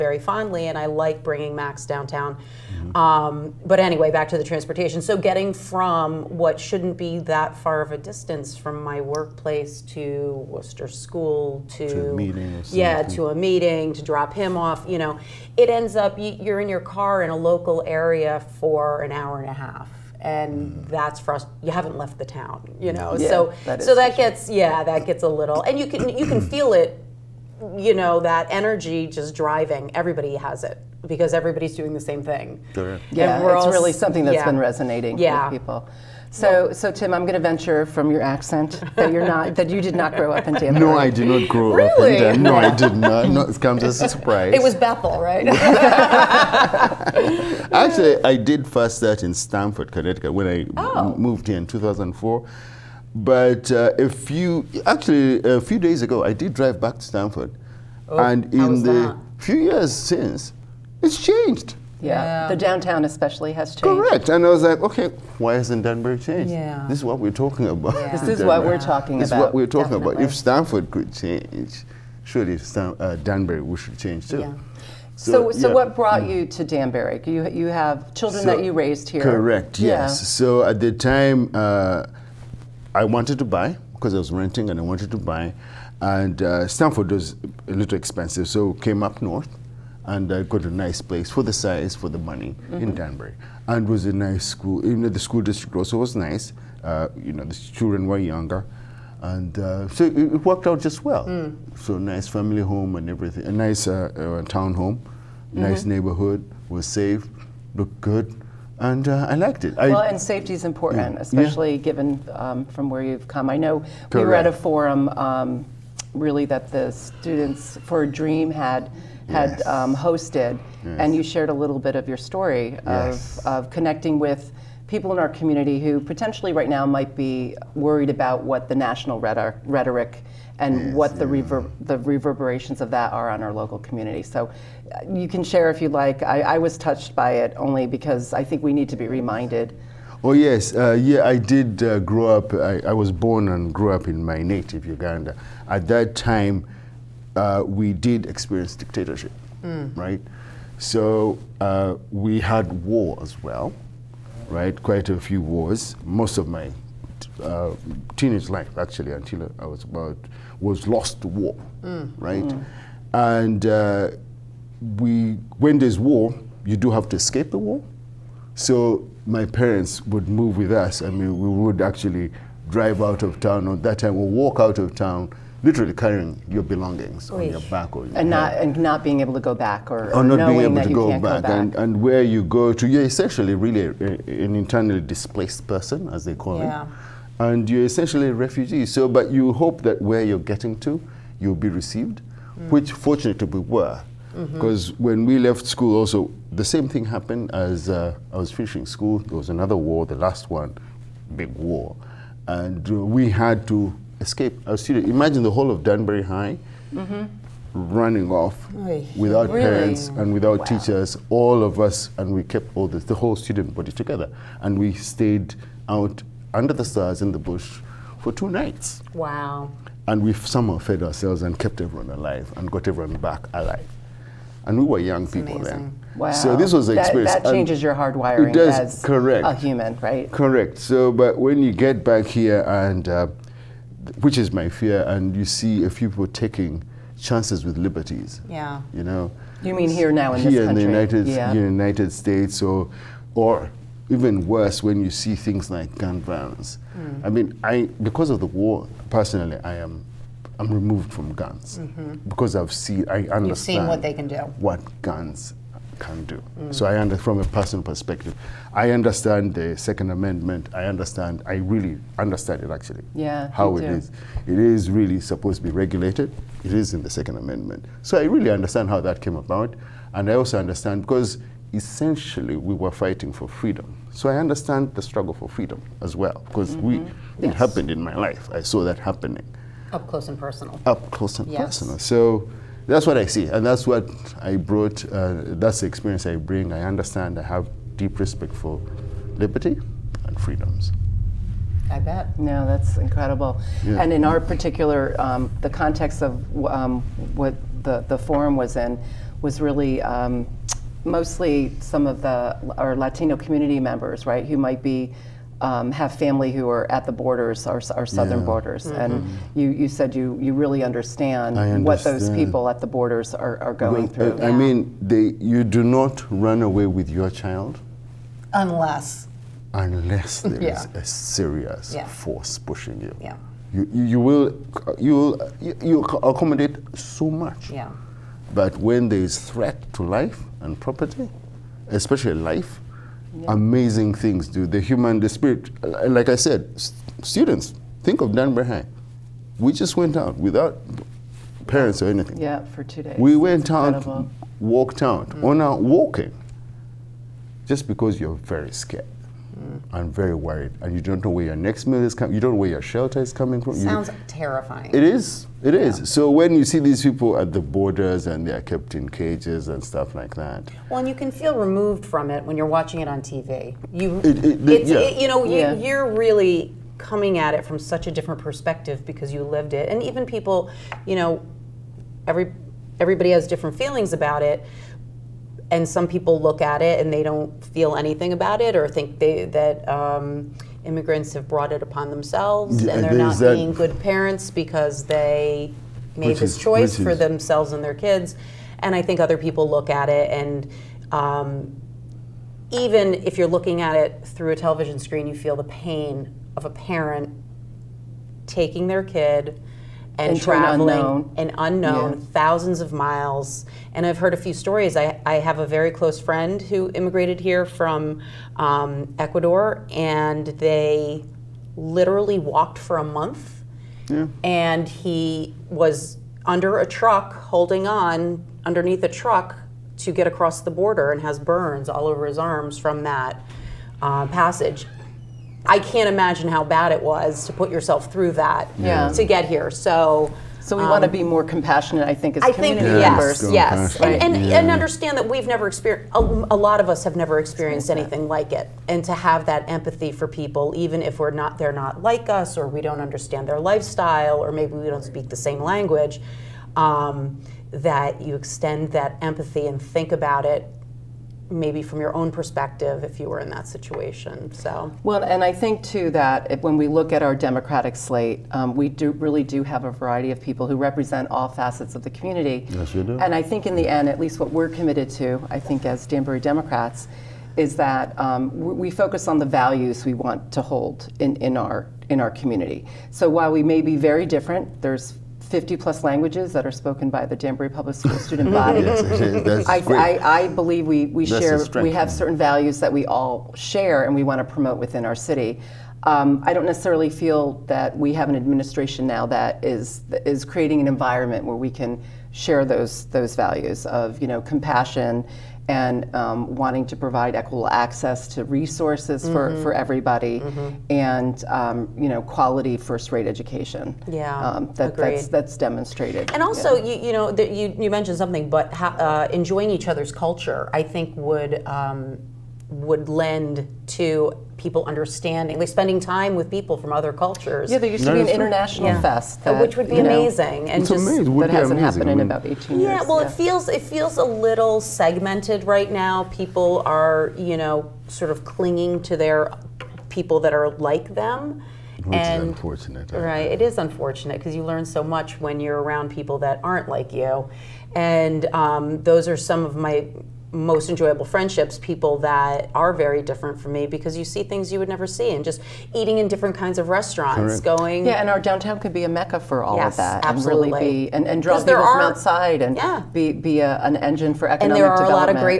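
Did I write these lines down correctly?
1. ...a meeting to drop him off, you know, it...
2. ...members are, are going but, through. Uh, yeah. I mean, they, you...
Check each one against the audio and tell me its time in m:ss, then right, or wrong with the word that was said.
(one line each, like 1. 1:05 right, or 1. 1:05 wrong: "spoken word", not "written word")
1. 0:13 right
2. 5:12 wrong: "borders", not "members".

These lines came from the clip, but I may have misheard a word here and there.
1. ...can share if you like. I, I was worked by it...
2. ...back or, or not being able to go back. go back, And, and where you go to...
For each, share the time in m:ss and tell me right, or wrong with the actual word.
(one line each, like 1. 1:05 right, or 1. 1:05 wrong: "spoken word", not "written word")
1. 2:15 wrong: "touched", not "worked"
2. 2:59 right.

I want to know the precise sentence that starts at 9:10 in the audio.
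and really be and, and draw people are, from outside and yeah.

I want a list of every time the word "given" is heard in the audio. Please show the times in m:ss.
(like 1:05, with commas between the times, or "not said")
1:51.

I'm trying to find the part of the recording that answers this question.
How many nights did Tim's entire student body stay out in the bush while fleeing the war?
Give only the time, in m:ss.
3:38.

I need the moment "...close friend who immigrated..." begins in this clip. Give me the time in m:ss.
6:45.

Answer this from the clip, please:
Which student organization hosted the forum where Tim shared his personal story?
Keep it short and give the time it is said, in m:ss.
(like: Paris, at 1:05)
Students for a Dream, at 1:56.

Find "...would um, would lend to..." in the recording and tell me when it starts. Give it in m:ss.
8:31.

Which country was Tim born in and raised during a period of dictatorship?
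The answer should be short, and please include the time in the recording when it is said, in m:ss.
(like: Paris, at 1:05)
Uganda, at 2:24.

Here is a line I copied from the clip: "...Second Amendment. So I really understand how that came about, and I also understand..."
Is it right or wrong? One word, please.
right.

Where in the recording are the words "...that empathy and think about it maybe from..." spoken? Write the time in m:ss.
7:28.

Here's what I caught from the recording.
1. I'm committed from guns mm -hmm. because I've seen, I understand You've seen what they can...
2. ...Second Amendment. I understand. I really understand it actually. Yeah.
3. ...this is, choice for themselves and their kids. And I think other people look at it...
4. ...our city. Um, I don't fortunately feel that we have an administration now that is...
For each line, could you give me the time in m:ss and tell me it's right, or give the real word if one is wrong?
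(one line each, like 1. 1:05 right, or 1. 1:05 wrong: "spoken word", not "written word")
1. 4:10 wrong: "removed", not "committed"
2. 4:19 right
3. 6:26 right
4. 8:05 wrong: "necessarily", not "fortunately".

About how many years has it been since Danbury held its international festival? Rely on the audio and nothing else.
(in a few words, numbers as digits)
18.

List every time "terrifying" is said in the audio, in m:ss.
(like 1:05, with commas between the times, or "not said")
5:54.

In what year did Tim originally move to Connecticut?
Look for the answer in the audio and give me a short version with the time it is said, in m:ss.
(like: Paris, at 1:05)
2004, at 0:51.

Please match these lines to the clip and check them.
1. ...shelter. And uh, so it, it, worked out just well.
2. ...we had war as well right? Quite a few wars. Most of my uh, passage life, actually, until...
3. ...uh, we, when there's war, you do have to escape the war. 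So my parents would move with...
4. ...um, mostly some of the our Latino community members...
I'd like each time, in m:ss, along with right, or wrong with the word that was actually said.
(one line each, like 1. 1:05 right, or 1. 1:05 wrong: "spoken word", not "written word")
1. 1:38 wrong: "younger", not "shelter"
2. 2:32 wrong: "teenage", not "passage"
3. 2:43 right
4. 5:00 right.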